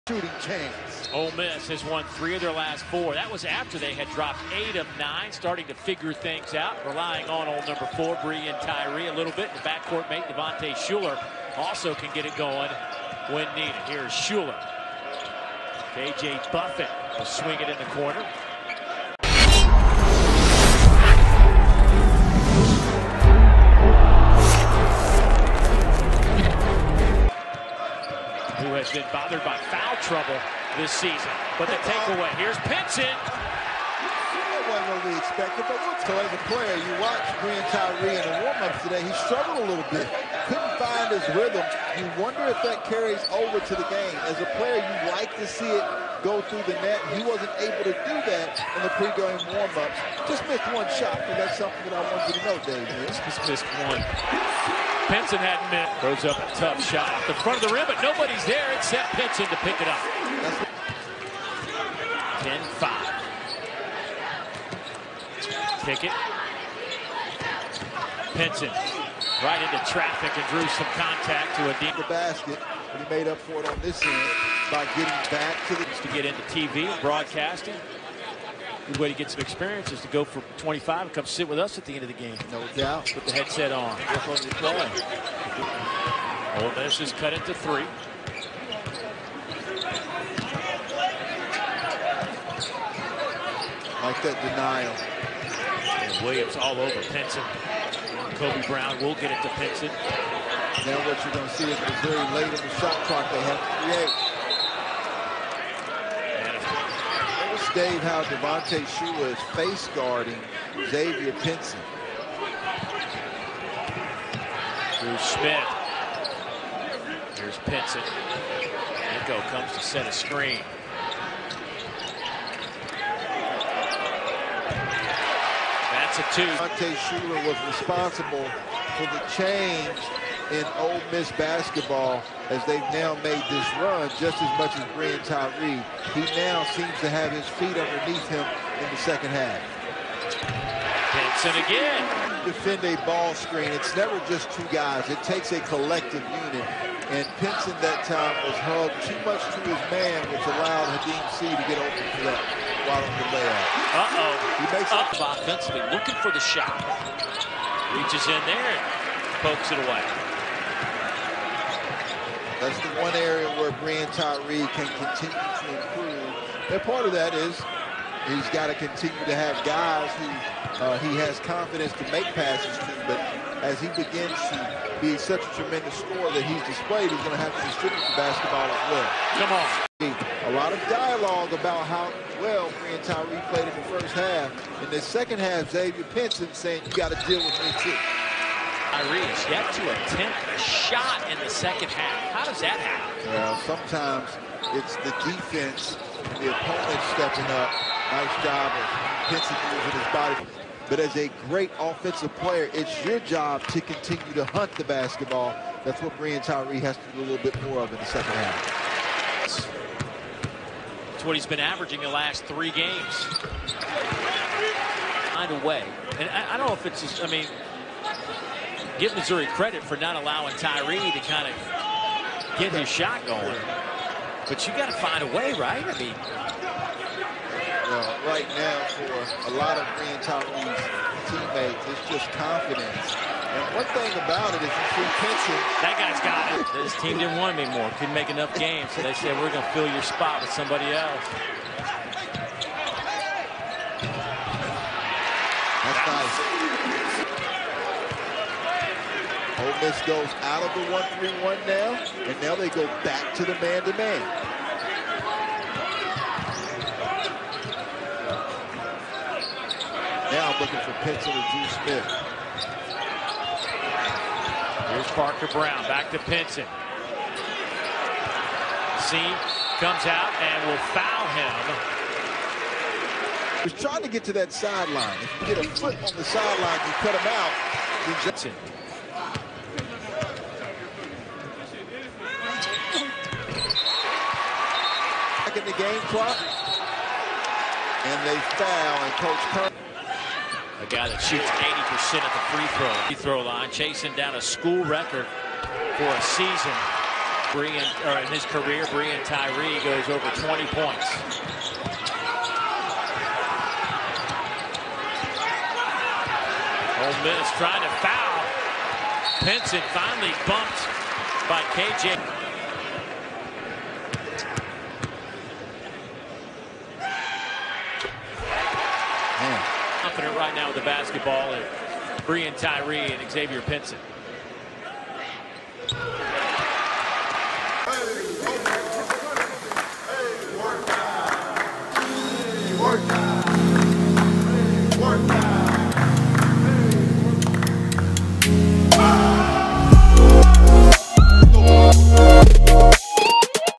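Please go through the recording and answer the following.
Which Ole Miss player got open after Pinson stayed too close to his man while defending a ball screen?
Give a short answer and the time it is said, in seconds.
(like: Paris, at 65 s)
Khadim Sy, at 150 s.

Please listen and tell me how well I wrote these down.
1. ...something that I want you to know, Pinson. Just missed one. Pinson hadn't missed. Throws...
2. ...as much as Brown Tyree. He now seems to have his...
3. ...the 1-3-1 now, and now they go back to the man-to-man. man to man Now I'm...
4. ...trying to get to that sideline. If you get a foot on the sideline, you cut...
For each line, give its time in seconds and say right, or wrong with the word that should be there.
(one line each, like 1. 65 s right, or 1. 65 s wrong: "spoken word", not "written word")
1. 51 s wrong: "Dave", not "Pinson"
2. 134 s wrong: "Breein", not "Brown"
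3. 250 s right
4. 273 s right.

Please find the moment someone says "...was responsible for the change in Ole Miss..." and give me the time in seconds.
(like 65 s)
127 s.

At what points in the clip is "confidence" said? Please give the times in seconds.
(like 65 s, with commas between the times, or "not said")
171 s, 232 s.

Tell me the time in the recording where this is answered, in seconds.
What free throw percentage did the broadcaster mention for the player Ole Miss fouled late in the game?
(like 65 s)
291 s.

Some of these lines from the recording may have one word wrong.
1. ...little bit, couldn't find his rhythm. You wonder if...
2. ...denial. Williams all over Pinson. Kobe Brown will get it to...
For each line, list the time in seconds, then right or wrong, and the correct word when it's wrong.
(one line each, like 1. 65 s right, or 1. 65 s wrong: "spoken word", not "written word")
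1. 39 s right
2. 94 s right.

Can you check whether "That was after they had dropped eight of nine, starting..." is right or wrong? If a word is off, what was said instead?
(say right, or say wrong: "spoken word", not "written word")
right.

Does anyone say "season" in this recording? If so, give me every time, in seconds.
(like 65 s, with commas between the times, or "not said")
30 s, 296 s.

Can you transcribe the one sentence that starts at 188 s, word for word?
Tyree has yet to attempt a shot in the second half.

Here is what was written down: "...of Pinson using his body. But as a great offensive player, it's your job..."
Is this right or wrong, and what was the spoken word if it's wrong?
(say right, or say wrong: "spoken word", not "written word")
right.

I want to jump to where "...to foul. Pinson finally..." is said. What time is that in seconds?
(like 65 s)
307 s.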